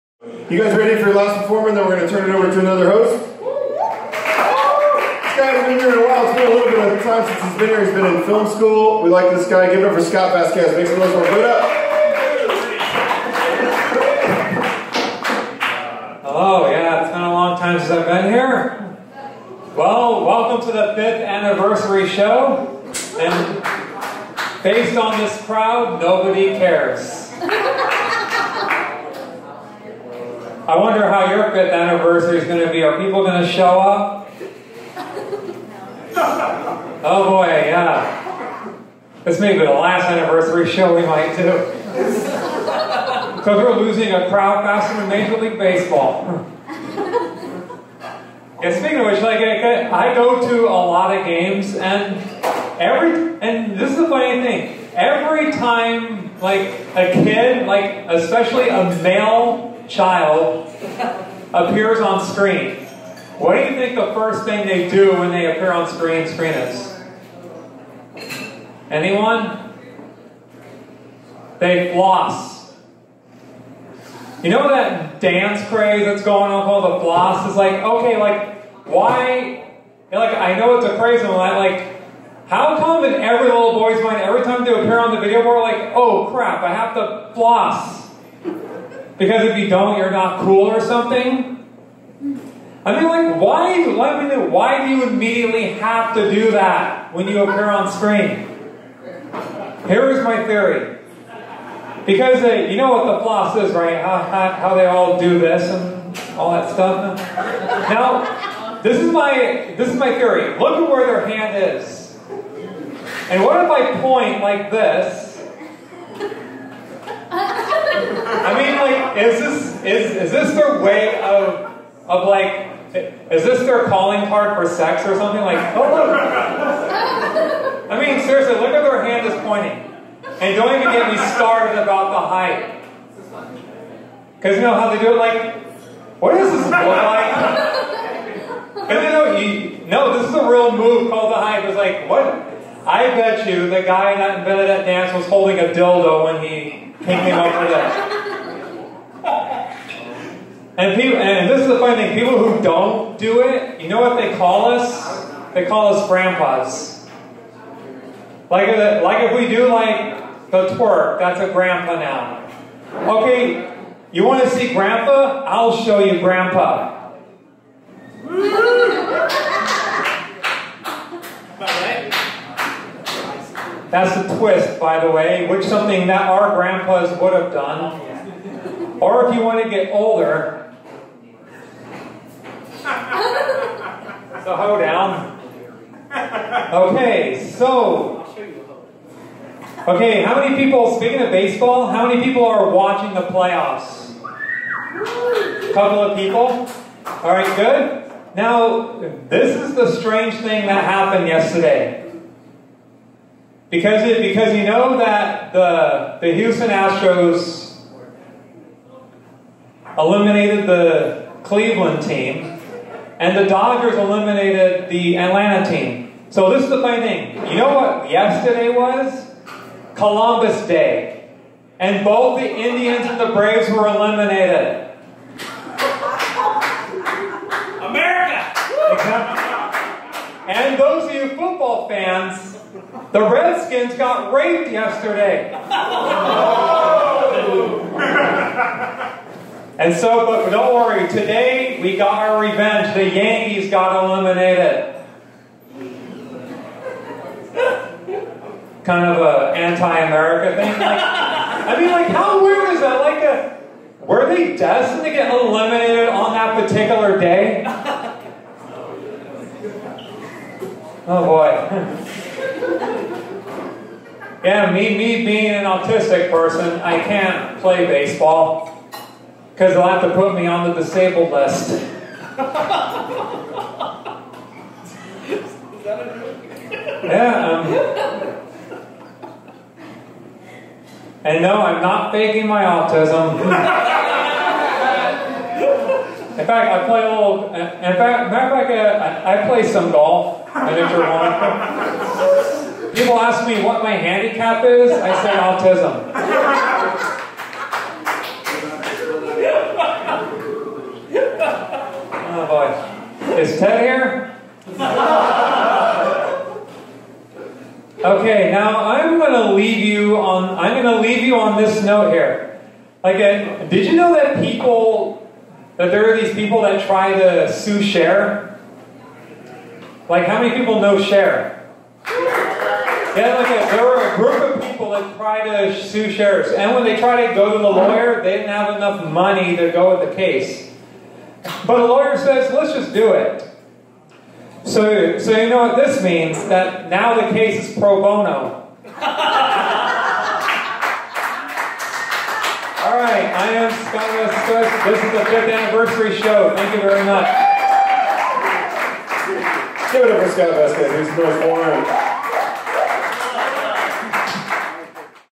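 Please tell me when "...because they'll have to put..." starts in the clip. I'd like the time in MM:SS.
04:29.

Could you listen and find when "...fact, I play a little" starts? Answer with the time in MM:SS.
04:46.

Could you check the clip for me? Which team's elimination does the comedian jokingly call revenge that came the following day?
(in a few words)
The Yankees.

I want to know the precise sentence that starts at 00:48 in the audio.
and speaking of which, like I go to a lot of games, and every and this is the funny thing.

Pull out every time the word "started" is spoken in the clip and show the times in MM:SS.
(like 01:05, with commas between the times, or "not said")
02:11.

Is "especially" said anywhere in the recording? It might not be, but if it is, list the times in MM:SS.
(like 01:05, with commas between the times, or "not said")
00:58.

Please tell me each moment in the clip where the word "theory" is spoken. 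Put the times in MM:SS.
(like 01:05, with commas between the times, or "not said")
01:40, 01:50.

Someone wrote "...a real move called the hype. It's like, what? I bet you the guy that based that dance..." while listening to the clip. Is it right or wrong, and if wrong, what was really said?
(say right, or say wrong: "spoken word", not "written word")
wrong: "invented", not "based".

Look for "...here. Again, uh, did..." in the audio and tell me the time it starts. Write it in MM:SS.
05:12.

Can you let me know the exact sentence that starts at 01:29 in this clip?
Because if you don't, you're not cool or something?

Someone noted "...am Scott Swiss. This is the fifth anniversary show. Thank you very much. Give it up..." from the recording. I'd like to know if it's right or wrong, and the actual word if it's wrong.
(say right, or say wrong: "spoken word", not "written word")
right.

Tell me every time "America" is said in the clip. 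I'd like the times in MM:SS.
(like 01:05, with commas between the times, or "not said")
03:47, 04:09.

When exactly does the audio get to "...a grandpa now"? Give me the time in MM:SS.
02:41.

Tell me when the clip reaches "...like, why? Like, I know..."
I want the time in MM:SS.
01:18.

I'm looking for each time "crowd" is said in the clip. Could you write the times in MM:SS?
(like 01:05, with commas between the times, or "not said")
00:25, 00:44.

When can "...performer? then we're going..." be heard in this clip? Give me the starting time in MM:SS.
00:01.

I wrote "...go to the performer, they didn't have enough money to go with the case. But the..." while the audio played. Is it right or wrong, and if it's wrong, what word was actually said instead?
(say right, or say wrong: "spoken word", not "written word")
wrong: "lawyer", not "performer".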